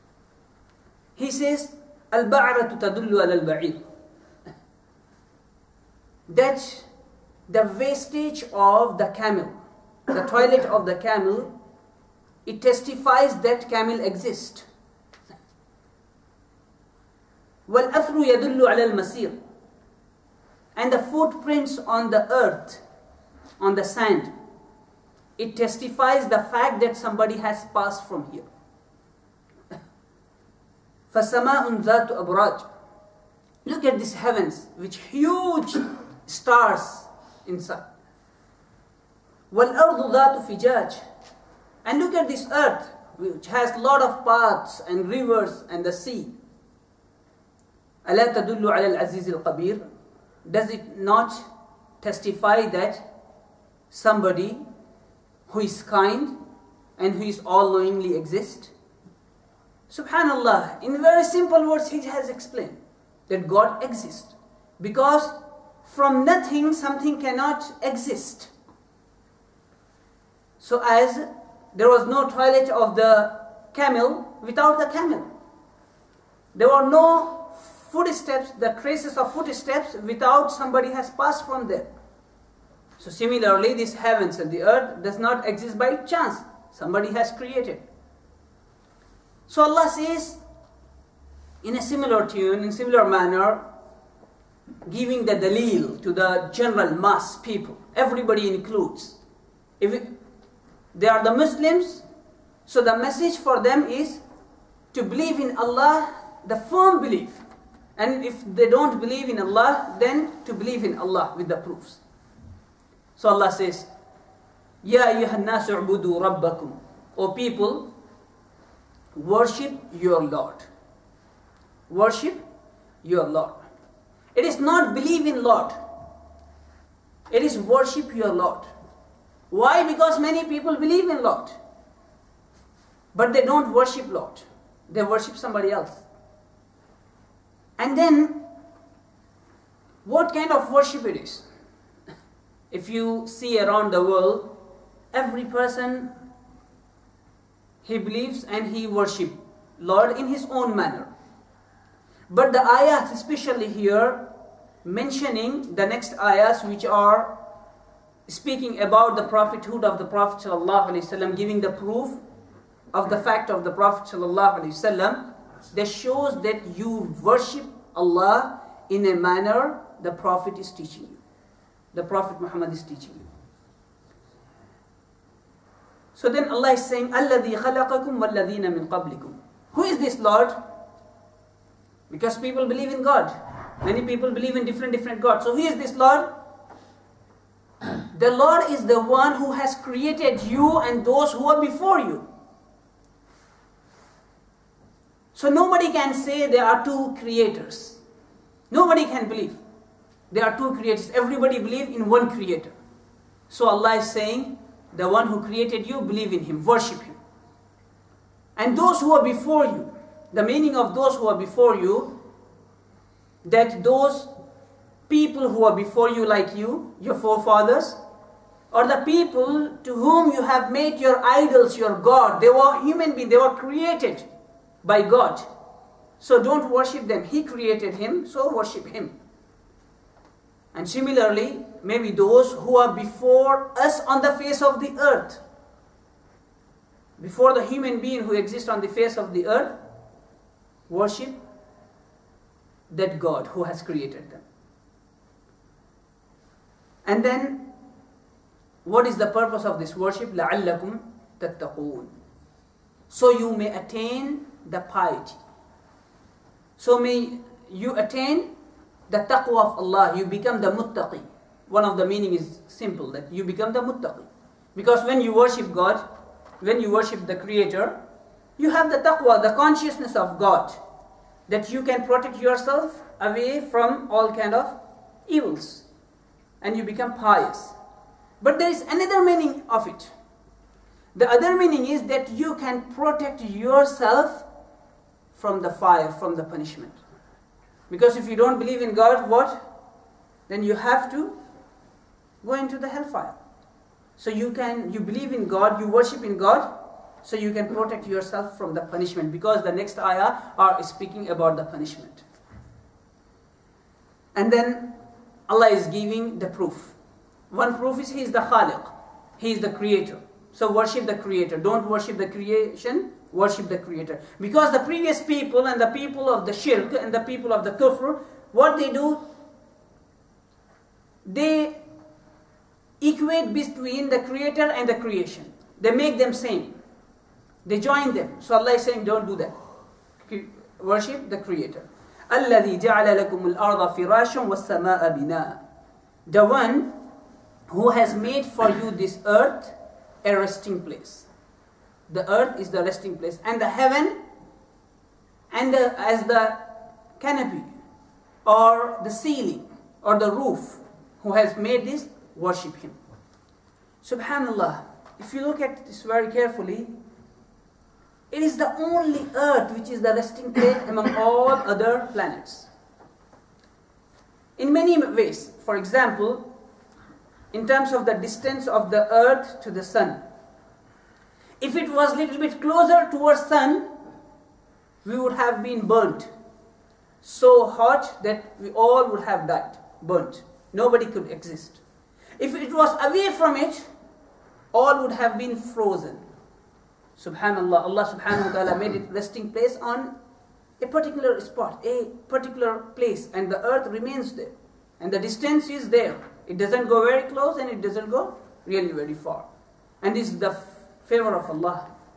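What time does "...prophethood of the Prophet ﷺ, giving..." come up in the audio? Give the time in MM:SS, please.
02:39.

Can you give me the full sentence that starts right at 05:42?
The earth is the resting place.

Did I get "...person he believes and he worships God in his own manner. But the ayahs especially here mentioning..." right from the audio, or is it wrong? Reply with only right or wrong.
wrong.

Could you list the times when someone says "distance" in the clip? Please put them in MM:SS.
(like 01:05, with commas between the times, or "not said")
06:08, 06:35.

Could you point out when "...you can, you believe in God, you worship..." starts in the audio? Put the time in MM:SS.
04:54.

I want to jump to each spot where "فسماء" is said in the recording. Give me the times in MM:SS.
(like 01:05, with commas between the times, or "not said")
00:31.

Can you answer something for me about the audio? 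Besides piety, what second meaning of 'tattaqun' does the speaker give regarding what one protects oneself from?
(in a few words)
The fire.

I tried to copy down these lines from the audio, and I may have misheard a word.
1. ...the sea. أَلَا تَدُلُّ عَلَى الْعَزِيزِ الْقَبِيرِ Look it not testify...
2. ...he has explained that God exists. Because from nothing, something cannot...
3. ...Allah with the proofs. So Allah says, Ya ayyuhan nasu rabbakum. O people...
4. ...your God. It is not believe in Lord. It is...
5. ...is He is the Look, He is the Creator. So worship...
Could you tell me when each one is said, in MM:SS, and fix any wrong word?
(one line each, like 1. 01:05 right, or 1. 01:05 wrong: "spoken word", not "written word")
1. 00:45 wrong: "Does", not "Look"
2. 01:01 right
3. 01:50 right
4. 02:03 wrong: "Lord", not "God"
5. 05:07 wrong: "Khaliq", not "Look".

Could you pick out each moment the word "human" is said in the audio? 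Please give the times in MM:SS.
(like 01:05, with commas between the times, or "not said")
03:42, 03:57.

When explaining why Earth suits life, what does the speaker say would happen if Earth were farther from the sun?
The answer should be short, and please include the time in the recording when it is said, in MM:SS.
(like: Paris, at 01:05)
Frozen, at 06:25.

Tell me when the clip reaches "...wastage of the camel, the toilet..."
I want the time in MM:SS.
00:07.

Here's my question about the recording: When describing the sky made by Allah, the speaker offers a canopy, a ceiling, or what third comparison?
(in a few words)
The roof.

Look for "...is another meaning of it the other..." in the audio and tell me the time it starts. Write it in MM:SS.
04:38.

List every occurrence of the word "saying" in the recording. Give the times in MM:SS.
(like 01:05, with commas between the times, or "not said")
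02:56, 03:24, 05:28.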